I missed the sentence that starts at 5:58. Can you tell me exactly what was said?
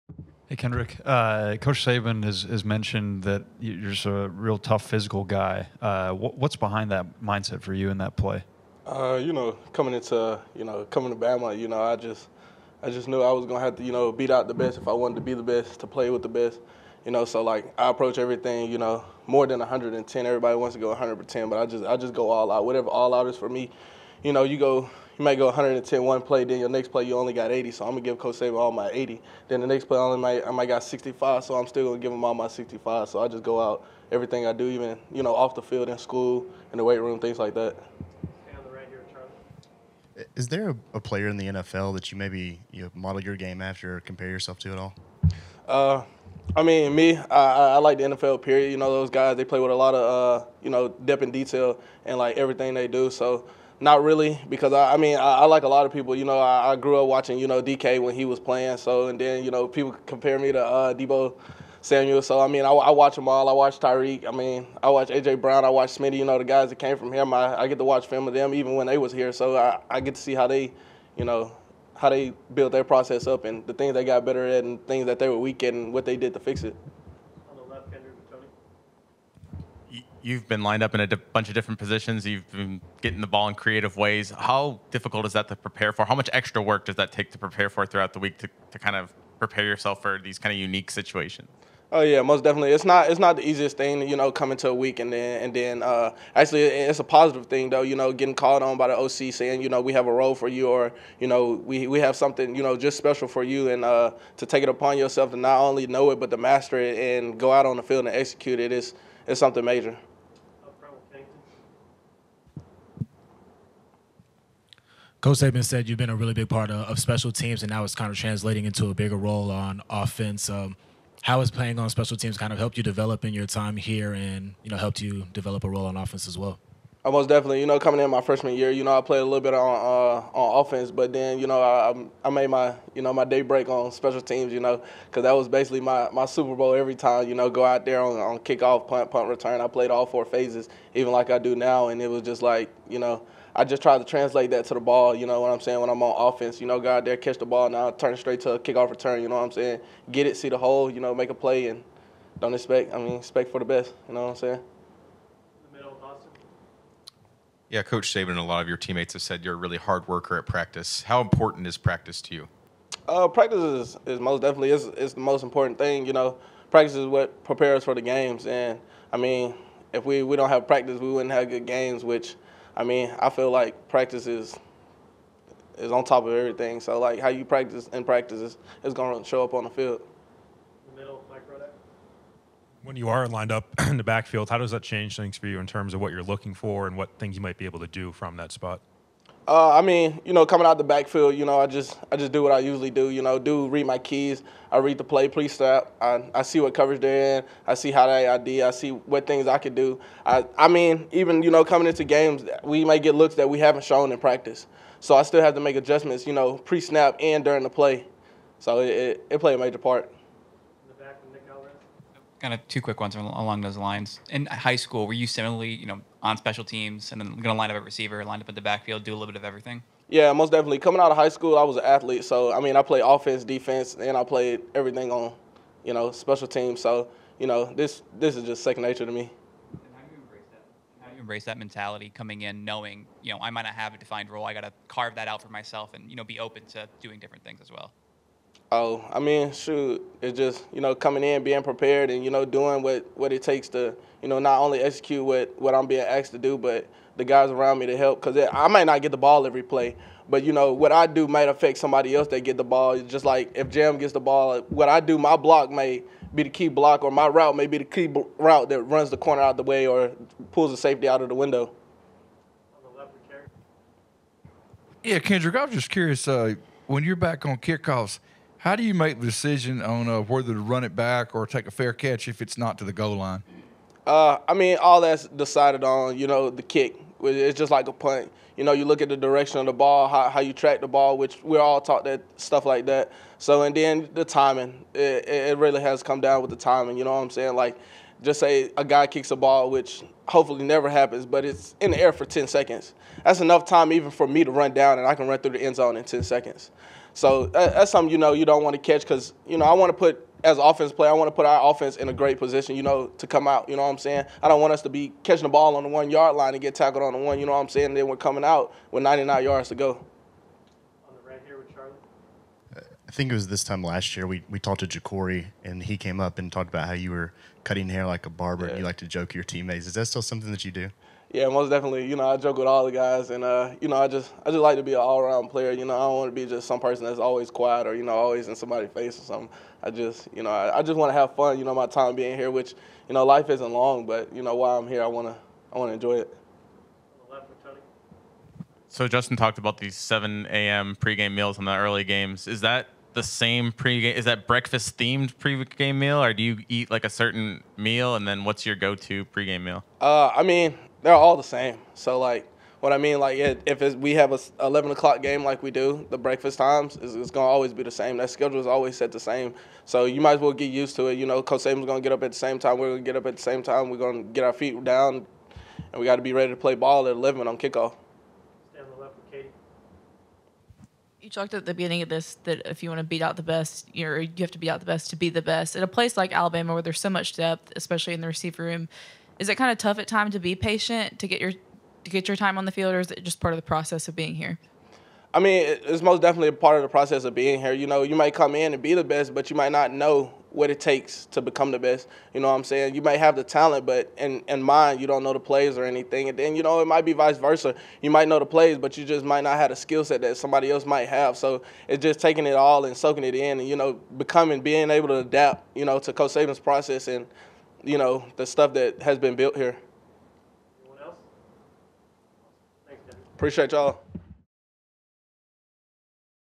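That schedule is always set the same.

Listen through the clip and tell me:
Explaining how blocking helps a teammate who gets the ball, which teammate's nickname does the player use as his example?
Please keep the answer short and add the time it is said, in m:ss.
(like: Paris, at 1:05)
Jam, at 4:13.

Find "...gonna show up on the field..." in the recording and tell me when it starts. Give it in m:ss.
2:58.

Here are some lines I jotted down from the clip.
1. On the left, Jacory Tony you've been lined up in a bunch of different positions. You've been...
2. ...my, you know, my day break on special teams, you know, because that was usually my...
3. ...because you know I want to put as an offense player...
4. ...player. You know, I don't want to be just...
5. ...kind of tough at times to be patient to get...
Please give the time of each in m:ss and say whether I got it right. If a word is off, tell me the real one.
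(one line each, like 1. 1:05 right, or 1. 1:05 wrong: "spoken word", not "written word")
1. 1:17 wrong: "Kendrick", not "Jacory"
2. 2:12 wrong: "basically", not "usually"
3. 4:59 right
4. 5:25 right
5. 6:19 right.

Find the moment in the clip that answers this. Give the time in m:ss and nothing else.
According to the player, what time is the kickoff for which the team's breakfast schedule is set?
5:54.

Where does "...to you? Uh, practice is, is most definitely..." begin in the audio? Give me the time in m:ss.
2:42.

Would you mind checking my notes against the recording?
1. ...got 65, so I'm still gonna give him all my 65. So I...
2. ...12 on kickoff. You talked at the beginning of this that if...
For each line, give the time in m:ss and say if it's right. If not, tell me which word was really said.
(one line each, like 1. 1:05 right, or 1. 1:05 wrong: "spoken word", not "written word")
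1. 0:30 right
2. 6:07 wrong: "11", not "12".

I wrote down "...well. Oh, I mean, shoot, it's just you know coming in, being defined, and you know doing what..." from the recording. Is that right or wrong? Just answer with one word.
wrong.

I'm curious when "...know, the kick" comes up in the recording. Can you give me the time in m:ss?
4:36.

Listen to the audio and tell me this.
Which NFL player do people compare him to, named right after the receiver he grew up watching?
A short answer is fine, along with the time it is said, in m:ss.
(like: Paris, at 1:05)
Deebo Samuel, at 1:00.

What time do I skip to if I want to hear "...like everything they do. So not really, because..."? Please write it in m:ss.
0:52.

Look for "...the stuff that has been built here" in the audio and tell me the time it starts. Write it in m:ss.
6:48.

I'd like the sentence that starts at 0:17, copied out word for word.
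You know, so like I approach everything, you know, more than 110.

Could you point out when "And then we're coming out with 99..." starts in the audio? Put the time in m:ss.
5:07.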